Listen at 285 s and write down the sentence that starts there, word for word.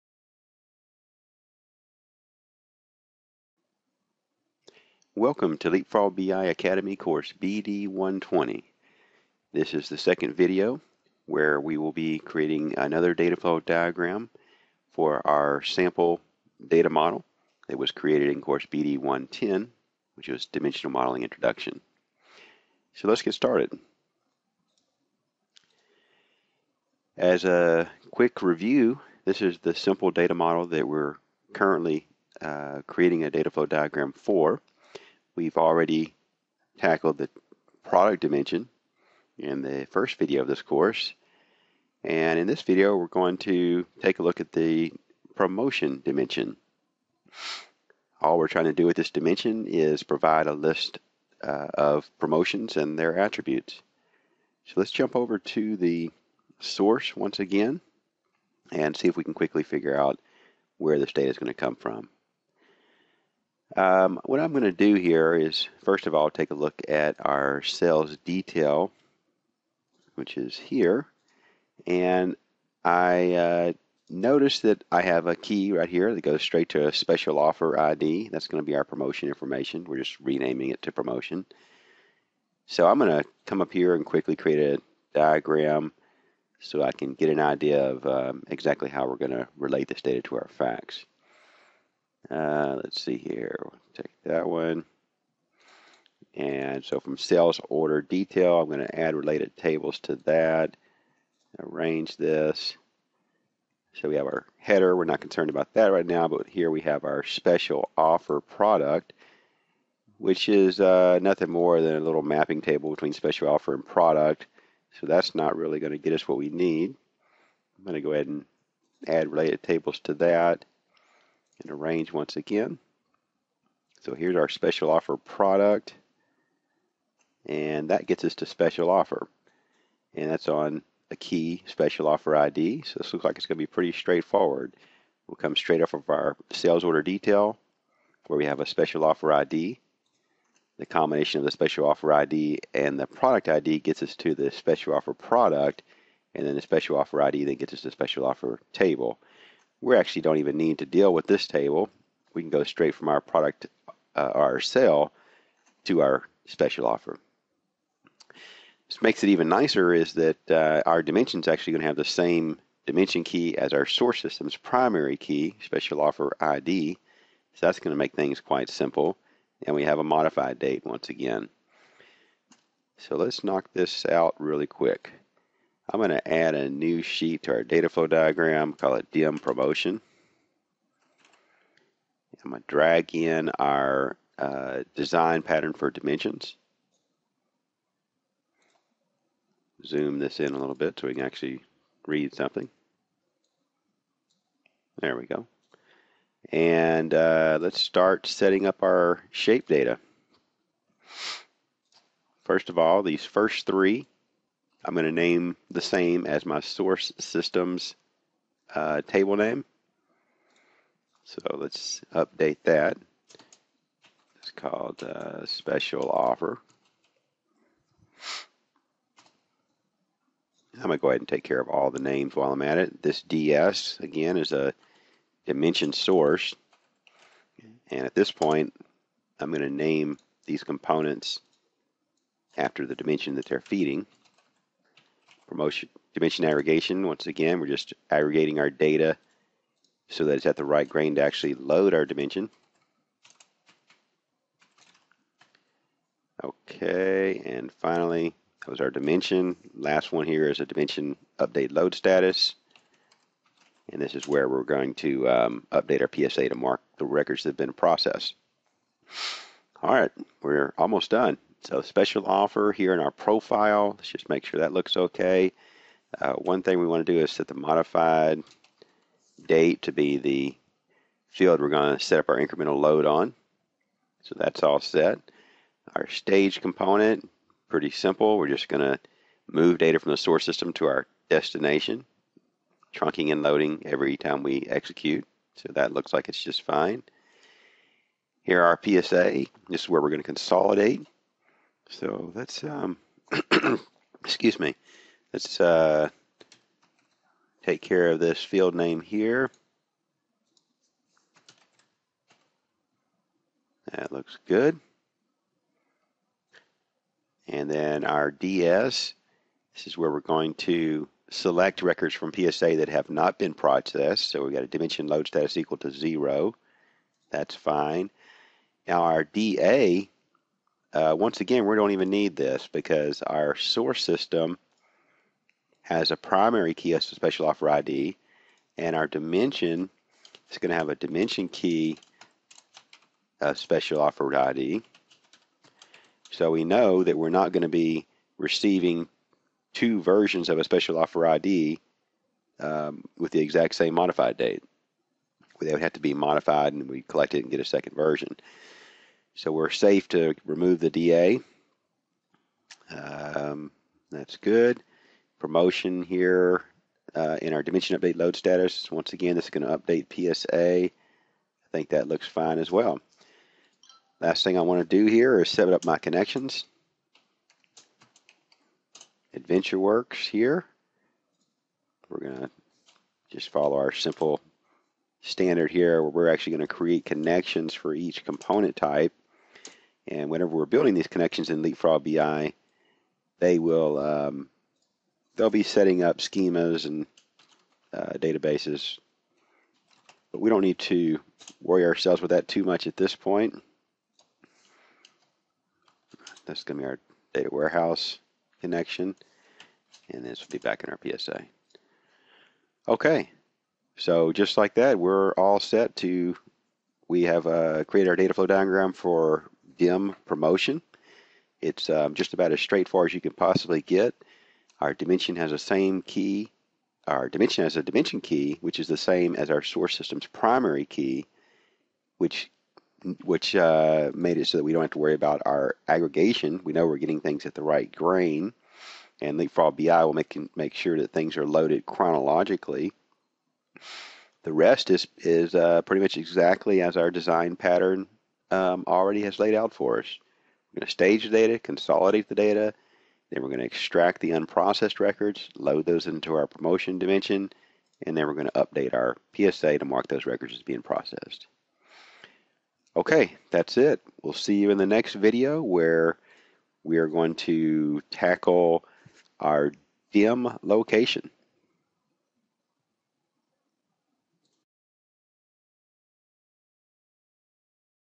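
So that looks like it's just fine.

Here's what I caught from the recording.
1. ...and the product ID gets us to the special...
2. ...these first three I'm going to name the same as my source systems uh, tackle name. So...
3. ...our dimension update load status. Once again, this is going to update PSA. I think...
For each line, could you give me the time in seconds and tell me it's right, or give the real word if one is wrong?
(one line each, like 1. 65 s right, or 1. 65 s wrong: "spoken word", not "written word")
1. 142 s right
2. 203 s wrong: "table", not "tackle"
3. 357 s right.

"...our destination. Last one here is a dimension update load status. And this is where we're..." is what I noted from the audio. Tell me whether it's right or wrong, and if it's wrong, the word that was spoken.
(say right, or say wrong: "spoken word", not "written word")
wrong: "dimension", not "destination".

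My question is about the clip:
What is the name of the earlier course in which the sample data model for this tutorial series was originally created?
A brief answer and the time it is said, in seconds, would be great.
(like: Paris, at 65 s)
BD110, at 18 s.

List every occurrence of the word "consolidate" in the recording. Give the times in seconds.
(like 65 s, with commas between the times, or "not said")
290 s, 441 s.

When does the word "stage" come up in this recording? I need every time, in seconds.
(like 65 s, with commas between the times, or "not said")
276 s, 440 s.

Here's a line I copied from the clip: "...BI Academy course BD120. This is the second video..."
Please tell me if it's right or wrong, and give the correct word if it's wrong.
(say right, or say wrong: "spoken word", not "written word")
right.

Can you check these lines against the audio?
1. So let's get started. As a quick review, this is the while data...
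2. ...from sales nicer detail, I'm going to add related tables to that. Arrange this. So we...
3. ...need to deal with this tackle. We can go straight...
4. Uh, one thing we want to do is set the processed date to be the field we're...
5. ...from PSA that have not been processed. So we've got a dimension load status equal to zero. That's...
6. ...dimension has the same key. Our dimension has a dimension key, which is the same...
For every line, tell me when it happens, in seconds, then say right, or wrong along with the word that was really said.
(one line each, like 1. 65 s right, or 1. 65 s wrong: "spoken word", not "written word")
1. 22 s wrong: "simple", not "while"
2. 97 s wrong: "order", not "nicer"
3. 150 s wrong: "table", not "tackle"
4. 266 s wrong: "modified", not "processed"
5. 312 s right
6. 414 s right.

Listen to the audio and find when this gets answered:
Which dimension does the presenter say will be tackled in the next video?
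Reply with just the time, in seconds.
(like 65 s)
460 s.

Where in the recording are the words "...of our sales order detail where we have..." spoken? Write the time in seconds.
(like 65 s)
135 s.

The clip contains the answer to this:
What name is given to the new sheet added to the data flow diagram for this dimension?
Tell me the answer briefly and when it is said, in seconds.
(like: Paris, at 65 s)
DM promotion, at 179 s.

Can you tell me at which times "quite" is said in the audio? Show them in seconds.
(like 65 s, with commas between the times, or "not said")
168 s.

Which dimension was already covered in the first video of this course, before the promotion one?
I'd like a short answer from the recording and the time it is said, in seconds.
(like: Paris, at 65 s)
product dimension, at 37 s.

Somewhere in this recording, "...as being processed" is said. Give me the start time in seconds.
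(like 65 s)
450 s.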